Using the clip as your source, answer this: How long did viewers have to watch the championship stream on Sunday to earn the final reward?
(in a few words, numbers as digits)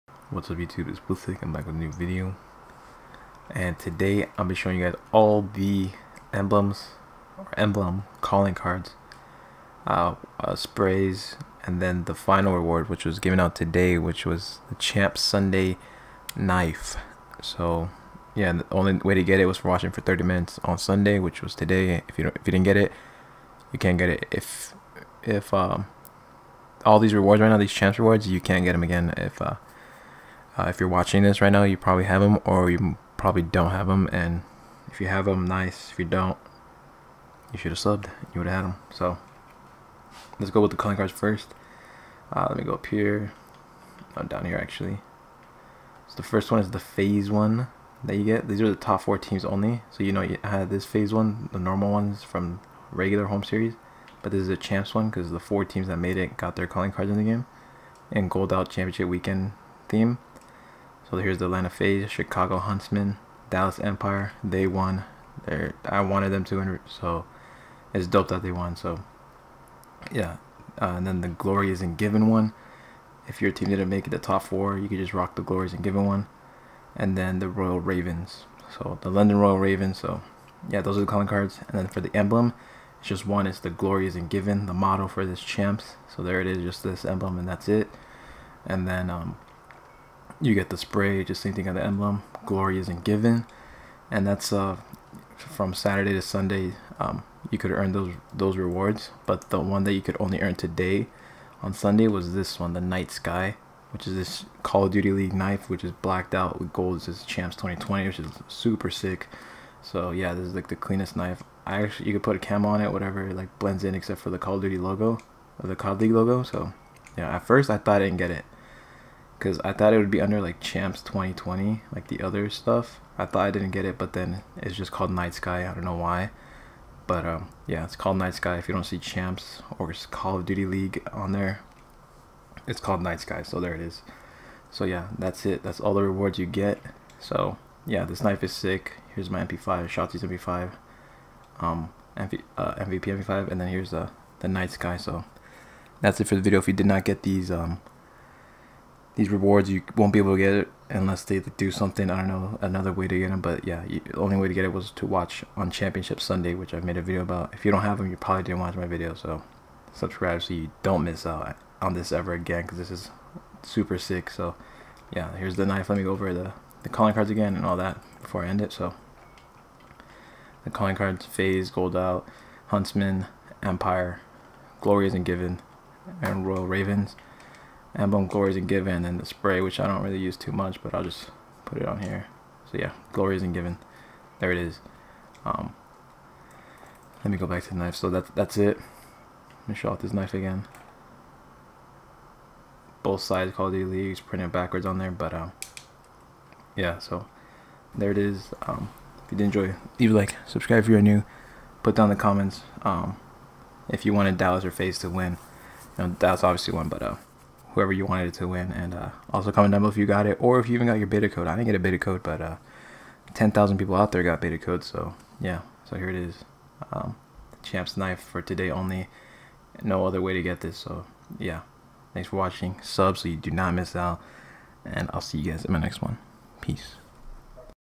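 30 minutes.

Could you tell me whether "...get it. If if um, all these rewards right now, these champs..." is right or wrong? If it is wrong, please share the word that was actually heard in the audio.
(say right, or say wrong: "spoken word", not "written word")
right.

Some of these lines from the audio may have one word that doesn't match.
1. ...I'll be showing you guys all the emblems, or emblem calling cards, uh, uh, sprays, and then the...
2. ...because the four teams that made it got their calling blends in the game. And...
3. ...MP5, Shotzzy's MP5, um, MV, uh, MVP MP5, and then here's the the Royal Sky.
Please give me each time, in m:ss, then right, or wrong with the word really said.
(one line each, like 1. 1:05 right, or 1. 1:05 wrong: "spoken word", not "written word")
1. 0:04 right
2. 0:55 wrong: "cards", not "blends"
3. 2:19 wrong: "Night", not "Royal".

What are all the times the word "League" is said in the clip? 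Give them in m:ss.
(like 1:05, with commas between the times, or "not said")
1:45, 1:55, 2:10, 3:13.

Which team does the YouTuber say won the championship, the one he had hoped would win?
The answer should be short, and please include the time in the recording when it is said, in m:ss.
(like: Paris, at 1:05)
Dallas Empire, at 1:03.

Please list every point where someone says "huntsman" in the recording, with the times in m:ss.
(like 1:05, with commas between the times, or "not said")
1:02, 2:52.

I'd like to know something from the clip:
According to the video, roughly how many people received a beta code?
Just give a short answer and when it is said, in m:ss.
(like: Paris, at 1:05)
10,000, at 3:33.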